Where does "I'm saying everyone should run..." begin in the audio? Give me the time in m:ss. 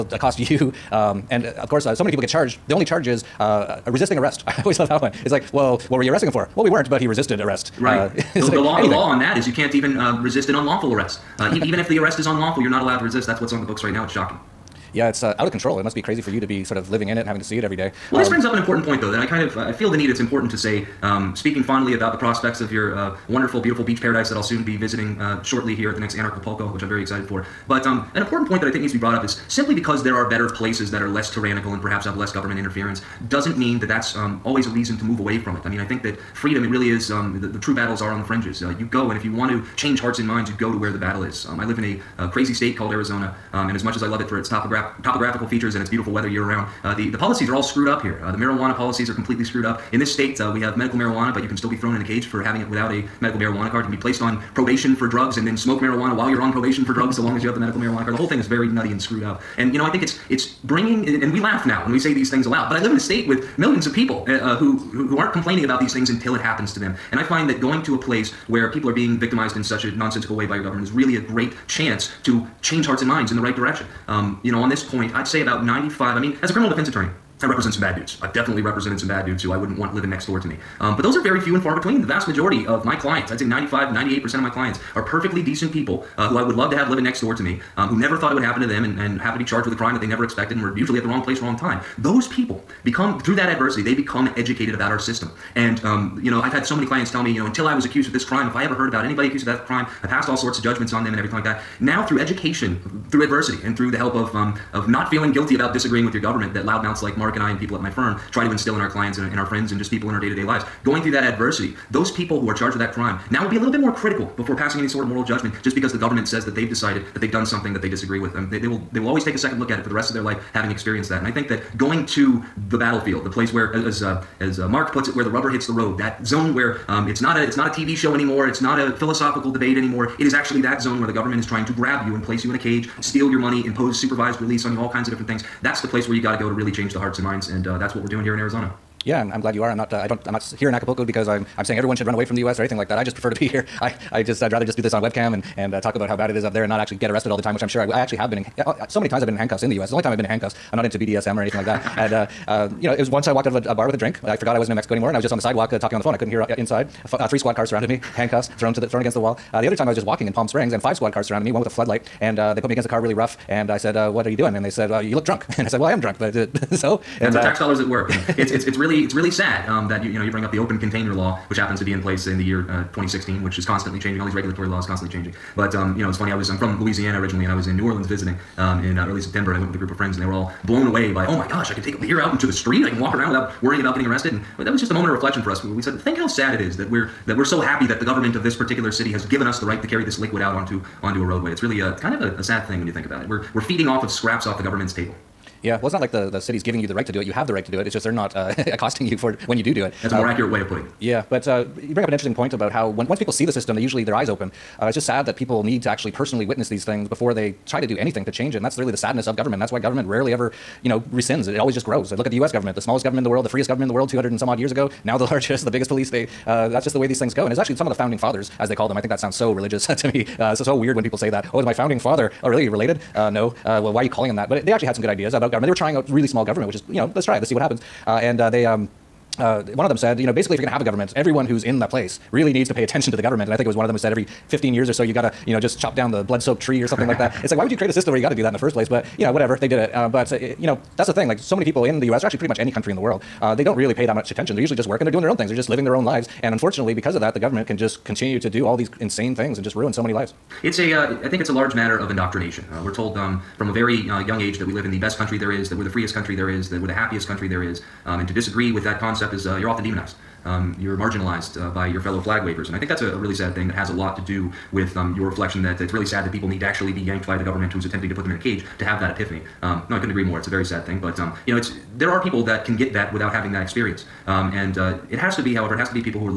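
2:21.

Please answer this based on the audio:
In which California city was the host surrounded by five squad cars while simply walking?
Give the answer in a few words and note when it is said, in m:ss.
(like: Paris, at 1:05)
Palm Springs, at 2:40.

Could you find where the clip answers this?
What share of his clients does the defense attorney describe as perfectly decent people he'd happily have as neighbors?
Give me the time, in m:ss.
1:23.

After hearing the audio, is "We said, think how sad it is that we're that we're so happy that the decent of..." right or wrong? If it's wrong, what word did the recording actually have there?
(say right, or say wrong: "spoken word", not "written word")
wrong: "government", not "decent".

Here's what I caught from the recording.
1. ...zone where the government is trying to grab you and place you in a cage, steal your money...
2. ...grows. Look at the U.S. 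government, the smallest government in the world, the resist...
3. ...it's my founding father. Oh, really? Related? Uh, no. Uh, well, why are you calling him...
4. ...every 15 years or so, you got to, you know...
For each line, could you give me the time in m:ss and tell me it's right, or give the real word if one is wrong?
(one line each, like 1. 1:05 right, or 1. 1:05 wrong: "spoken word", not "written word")
1. 2:10 right
2. 3:31 wrong: "freest", not "resist"
3. 3:41 right
4. 3:54 right.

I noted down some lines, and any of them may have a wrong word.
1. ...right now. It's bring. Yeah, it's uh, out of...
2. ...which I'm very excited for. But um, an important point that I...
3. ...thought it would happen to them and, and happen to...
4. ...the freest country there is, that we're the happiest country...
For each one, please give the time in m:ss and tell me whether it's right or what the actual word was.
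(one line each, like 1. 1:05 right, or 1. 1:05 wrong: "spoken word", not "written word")
1. 0:13 wrong: "shocking", not "bring"
2. 0:26 right
3. 1:28 right
4. 4:15 right.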